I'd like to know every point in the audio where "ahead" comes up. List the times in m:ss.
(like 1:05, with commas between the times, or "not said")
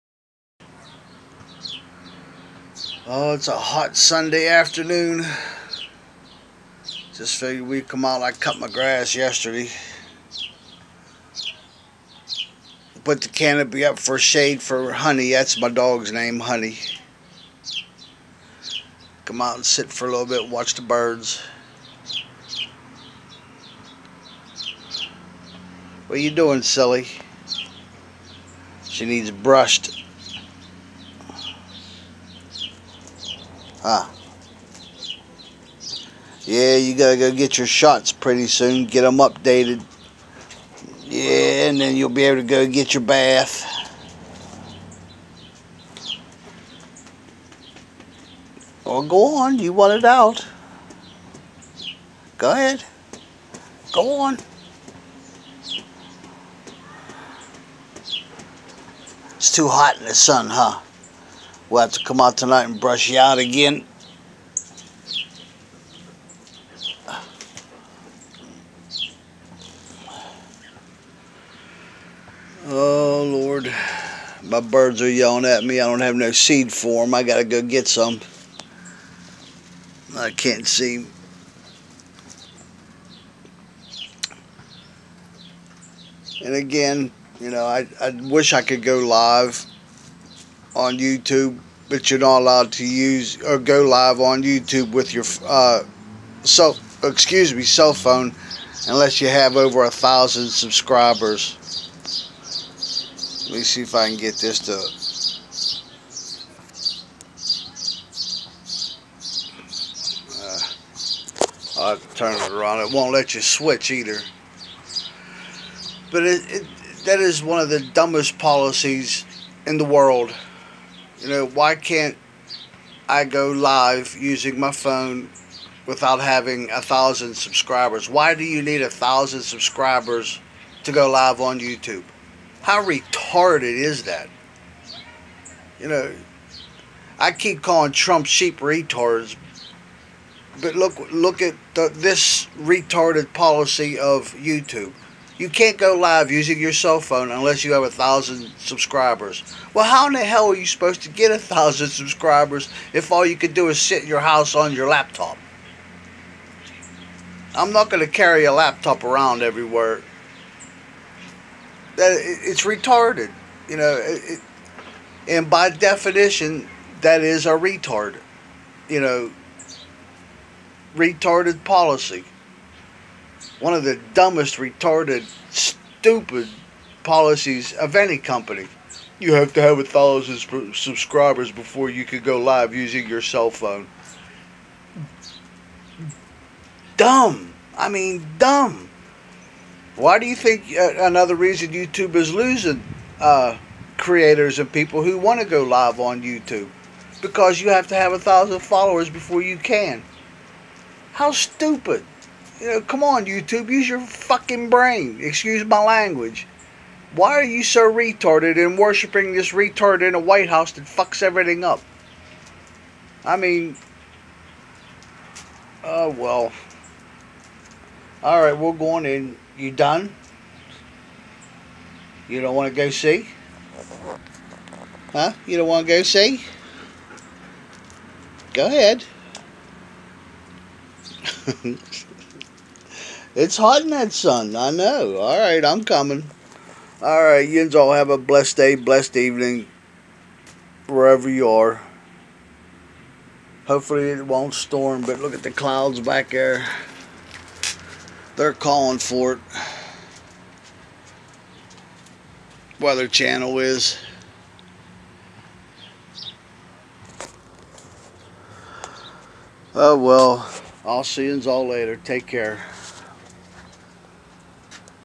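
0:52, 3:48.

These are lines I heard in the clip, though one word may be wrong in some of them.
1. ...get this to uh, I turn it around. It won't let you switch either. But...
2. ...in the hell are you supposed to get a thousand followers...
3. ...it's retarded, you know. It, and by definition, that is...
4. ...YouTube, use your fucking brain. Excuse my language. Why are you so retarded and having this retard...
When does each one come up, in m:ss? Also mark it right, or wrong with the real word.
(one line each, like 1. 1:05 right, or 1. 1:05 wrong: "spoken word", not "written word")
1. 1:44 right
2. 2:30 wrong: "subscribers", not "followers"
3. 2:42 right
4. 3:23 wrong: "worshiping", not "having".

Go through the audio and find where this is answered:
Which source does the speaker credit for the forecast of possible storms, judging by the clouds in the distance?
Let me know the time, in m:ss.
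4:12.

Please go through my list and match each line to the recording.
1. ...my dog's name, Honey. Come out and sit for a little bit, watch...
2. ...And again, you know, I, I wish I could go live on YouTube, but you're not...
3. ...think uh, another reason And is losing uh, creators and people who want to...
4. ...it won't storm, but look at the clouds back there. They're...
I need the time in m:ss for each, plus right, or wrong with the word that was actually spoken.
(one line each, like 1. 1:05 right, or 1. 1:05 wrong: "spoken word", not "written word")
1. 0:15 right
2. 1:26 right
3. 3:10 wrong: "YouTube", not "And"
4. 4:04 right.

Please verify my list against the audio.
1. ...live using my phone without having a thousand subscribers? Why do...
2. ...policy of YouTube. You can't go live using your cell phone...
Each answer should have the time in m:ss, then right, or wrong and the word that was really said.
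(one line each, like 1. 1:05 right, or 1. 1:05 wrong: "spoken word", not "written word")
1. 2:03 right
2. 2:23 right.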